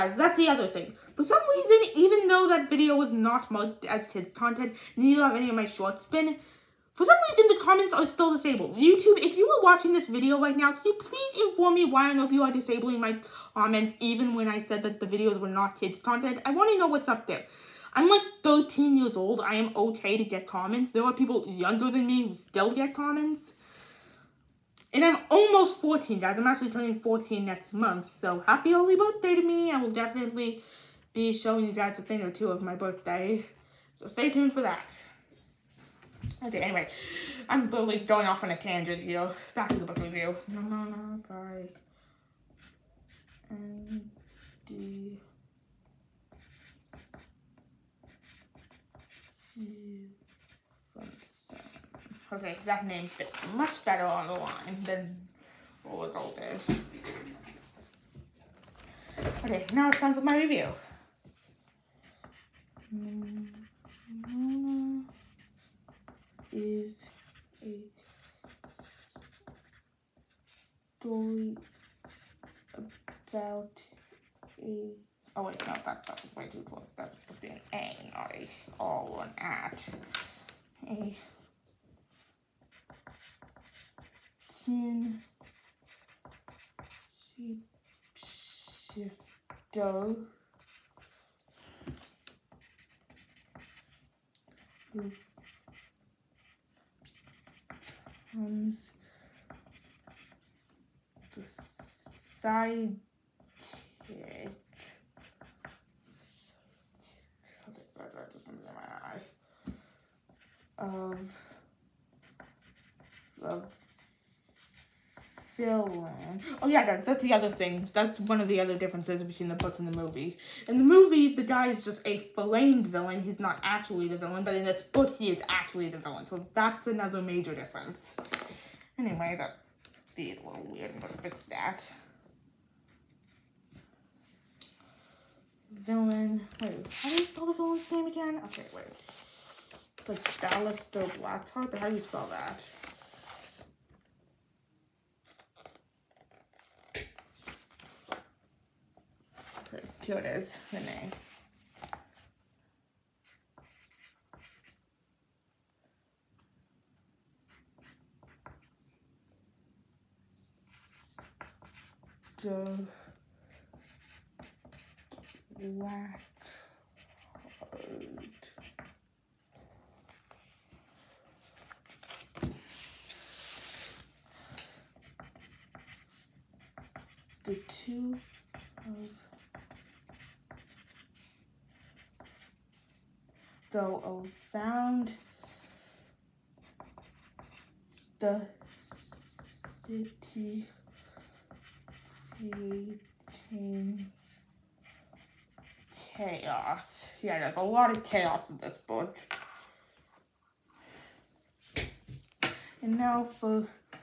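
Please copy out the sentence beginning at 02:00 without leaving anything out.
In the movie, the guy is just a flamed villain.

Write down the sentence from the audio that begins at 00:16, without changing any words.
I want to know what's up there.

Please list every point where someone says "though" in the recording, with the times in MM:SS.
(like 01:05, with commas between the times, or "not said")
00:02, 03:03.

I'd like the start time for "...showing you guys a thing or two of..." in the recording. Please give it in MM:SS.
00:31.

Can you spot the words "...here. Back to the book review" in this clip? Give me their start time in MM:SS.
00:39.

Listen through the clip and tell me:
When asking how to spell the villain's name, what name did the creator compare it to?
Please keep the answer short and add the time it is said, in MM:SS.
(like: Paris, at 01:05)
Ballister Blackheart, at 02:20.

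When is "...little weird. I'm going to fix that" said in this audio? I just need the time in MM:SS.
02:10.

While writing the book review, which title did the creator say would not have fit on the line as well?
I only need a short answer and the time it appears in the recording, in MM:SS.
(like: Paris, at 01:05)
Roller Girl, at 00:55.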